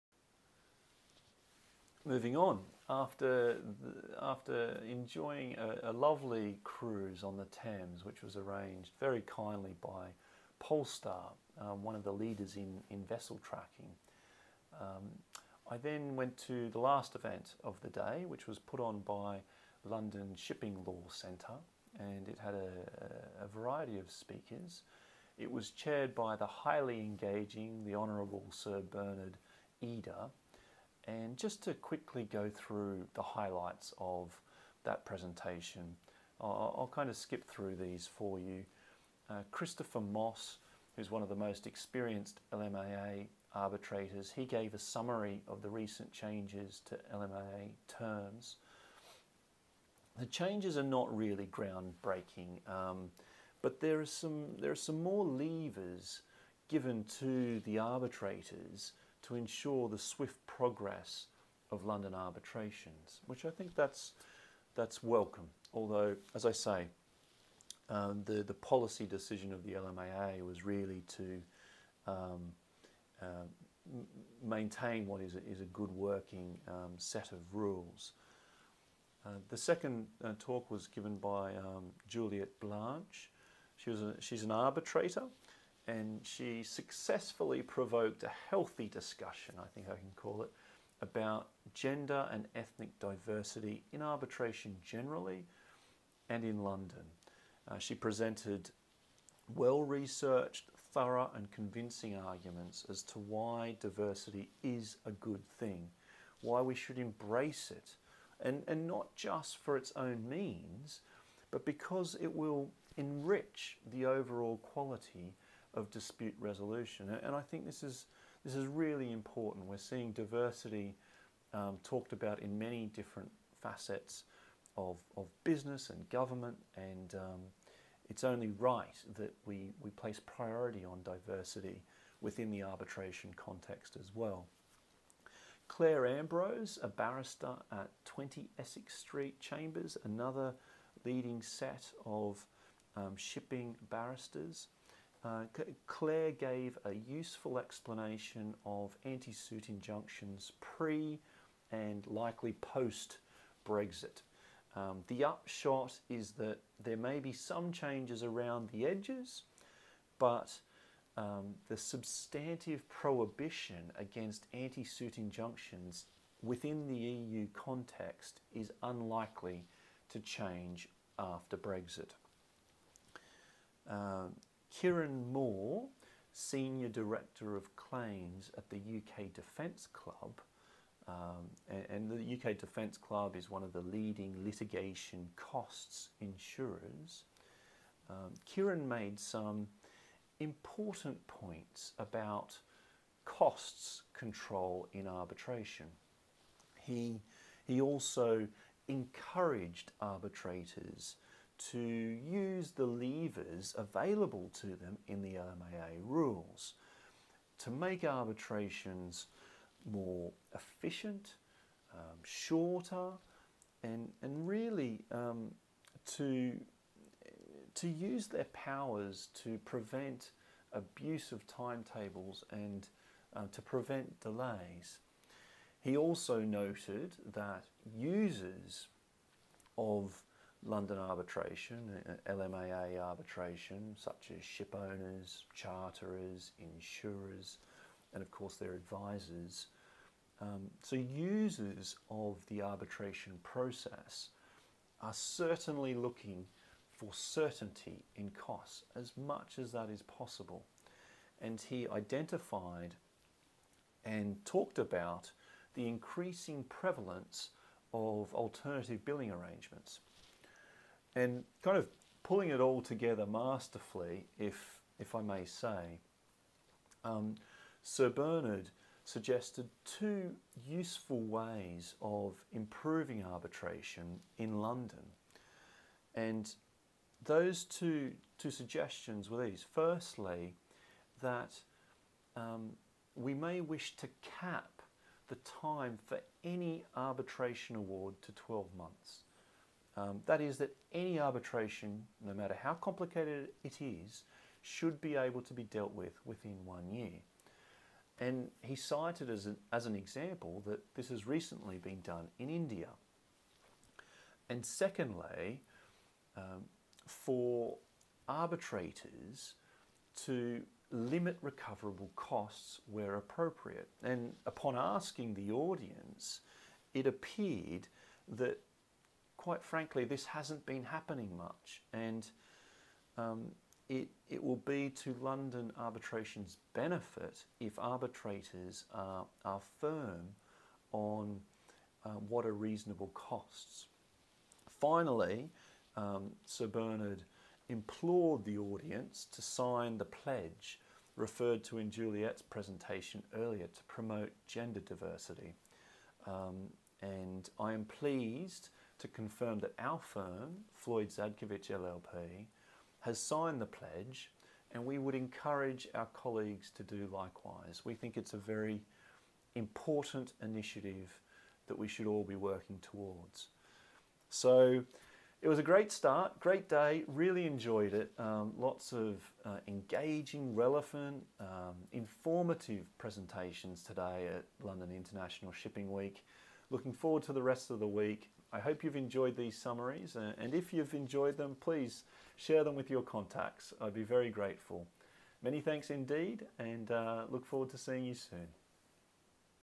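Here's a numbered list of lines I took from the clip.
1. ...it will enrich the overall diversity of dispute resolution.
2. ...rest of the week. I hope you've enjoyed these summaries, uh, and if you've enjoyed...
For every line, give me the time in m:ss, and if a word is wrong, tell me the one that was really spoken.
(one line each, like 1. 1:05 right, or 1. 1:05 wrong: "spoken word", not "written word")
1. 1:52 wrong: "quality", not "diversity"
2. 6:17 right.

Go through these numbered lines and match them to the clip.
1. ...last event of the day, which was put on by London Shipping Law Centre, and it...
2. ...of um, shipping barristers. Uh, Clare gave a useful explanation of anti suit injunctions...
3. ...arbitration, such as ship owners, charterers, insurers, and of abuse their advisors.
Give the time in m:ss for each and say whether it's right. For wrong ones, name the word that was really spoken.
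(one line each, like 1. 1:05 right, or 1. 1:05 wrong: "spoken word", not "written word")
1. 0:16 right
2. 2:22 right
3. 3:53 wrong: "course", not "abuse".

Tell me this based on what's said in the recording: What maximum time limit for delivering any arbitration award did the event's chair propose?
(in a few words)
12 months.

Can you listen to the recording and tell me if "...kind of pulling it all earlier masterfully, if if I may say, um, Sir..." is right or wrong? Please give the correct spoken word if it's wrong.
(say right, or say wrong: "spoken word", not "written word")
wrong: "together", not "earlier".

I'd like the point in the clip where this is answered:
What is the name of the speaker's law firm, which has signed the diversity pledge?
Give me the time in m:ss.
5:50.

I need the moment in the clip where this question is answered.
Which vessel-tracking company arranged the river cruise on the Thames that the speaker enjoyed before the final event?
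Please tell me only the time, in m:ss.
0:10.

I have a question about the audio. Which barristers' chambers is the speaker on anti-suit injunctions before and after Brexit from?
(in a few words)
20 Essex Street Chambers.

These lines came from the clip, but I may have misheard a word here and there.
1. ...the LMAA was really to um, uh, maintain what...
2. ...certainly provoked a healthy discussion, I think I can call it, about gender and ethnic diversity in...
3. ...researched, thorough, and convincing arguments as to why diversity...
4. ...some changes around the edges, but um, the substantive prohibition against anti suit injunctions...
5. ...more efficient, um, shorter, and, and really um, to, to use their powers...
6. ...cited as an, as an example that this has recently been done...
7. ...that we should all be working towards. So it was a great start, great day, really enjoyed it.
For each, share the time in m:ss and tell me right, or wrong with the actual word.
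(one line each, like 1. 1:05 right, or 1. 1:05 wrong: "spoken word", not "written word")
1. 1:09 right
2. 1:26 wrong: "successfully", not "certainly"
3. 1:39 right
4. 2:37 right
5. 3:29 right
6. 4:58 right
7. 6:01 right.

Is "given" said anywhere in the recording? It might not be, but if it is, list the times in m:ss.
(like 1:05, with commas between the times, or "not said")
0:56, 1:20.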